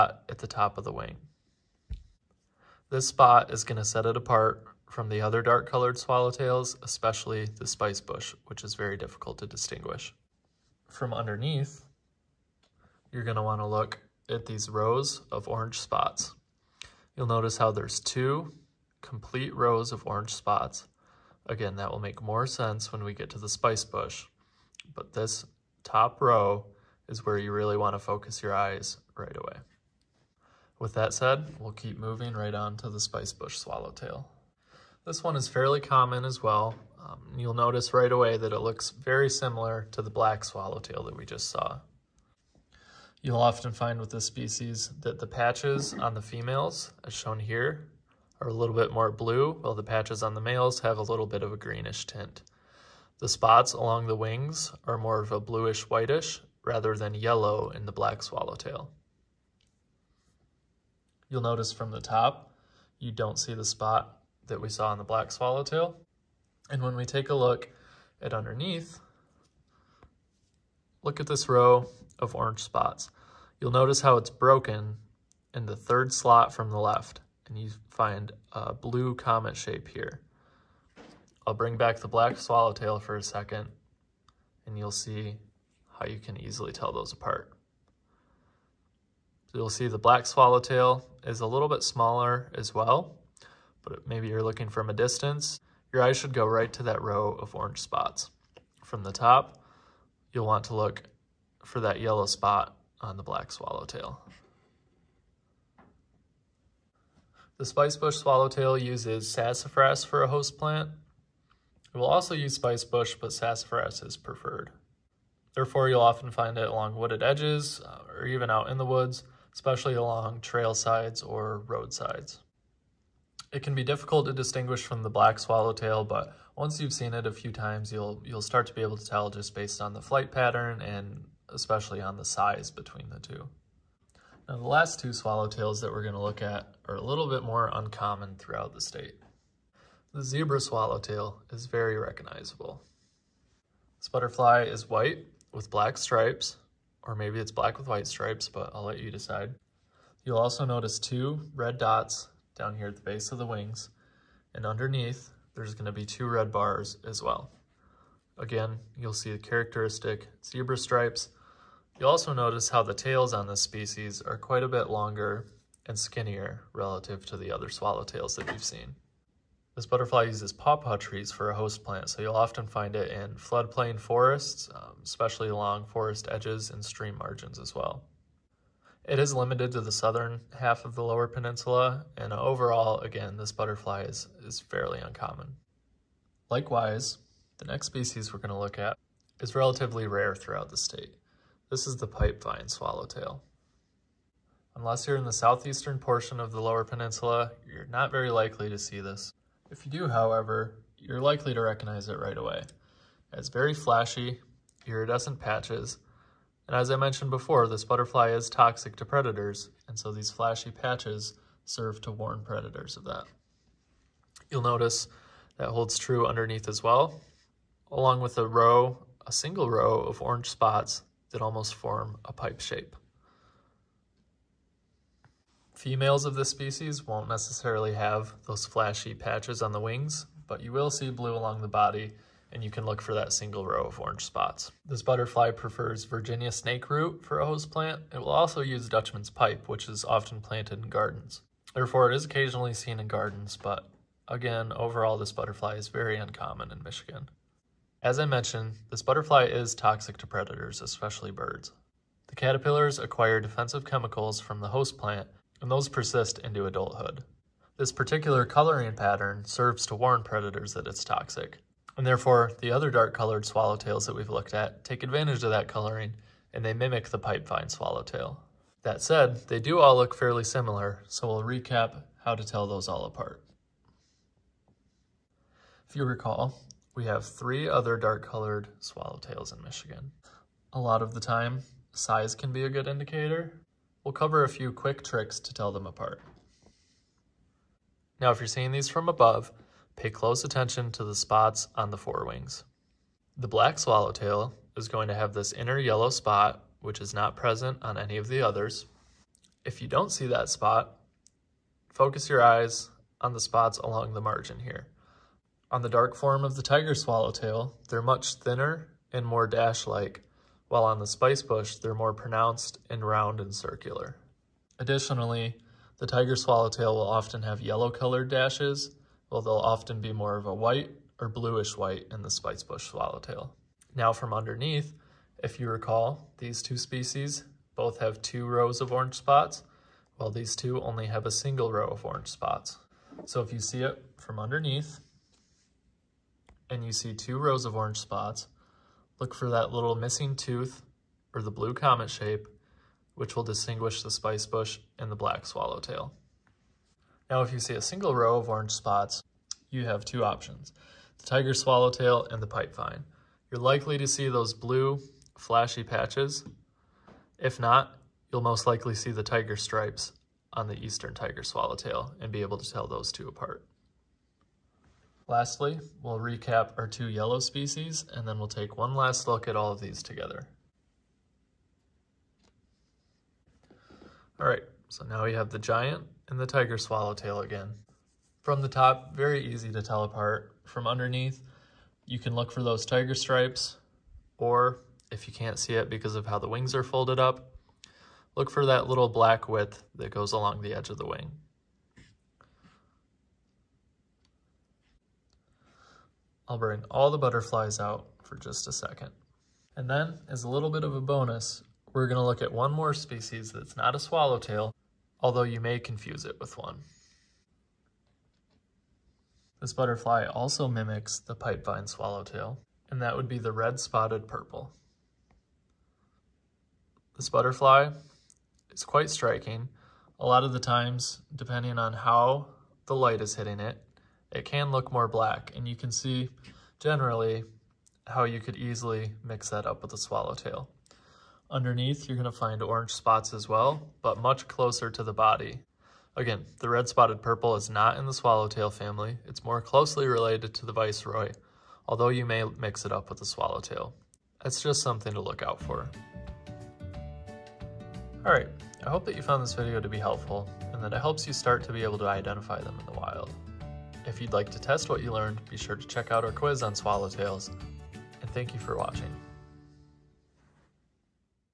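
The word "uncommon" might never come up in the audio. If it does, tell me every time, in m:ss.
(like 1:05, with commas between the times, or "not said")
2:17, 3:04, 4:06.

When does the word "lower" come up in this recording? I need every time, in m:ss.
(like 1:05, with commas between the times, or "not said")
3:01, 3:16.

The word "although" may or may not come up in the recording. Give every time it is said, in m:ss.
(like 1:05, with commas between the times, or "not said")
6:45, 7:21.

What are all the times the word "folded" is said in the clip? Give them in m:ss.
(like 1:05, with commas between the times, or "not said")
6:26.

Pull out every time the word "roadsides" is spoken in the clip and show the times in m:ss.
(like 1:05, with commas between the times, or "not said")
2:01.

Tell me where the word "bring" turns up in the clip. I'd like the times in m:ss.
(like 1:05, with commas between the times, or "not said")
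1:21, 6:36.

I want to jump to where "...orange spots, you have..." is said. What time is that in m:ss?
5:48.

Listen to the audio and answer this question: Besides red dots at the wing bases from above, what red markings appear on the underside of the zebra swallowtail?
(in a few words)
Two red bars.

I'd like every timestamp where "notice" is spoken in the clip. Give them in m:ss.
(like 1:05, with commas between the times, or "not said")
0:17, 0:37, 1:01, 1:13, 2:30, 2:42, 3:34.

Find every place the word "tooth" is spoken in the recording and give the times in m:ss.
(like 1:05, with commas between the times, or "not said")
5:40.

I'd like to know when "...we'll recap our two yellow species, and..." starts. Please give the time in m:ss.
6:06.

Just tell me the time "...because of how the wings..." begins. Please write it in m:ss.
6:25.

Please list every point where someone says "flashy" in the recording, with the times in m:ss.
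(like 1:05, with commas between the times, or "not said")
3:23, 3:30, 3:48, 5:55.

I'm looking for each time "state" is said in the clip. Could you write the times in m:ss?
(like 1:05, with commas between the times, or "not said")
2:18, 3:10.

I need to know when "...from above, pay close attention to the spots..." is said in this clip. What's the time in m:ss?
4:48.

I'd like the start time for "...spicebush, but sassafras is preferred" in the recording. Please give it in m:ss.
1:52.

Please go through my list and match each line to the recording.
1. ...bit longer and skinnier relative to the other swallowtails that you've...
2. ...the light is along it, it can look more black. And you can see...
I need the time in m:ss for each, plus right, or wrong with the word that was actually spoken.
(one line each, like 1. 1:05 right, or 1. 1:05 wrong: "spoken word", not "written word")
1. 2:44 right
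2. 7:02 wrong: "hitting", not "along".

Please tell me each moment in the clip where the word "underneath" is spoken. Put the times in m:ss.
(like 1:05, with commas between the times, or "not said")
0:11, 1:08, 2:34, 3:36, 5:24, 5:34, 6:20, 7:11.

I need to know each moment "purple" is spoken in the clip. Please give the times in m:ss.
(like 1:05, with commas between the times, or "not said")
6:54, 7:17.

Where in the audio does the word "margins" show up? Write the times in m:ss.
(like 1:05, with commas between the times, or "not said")
2:57, 5:04.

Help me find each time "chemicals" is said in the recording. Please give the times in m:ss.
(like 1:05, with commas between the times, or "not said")
4:13.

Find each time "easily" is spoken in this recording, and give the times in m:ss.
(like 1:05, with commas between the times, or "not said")
1:26, 7:08.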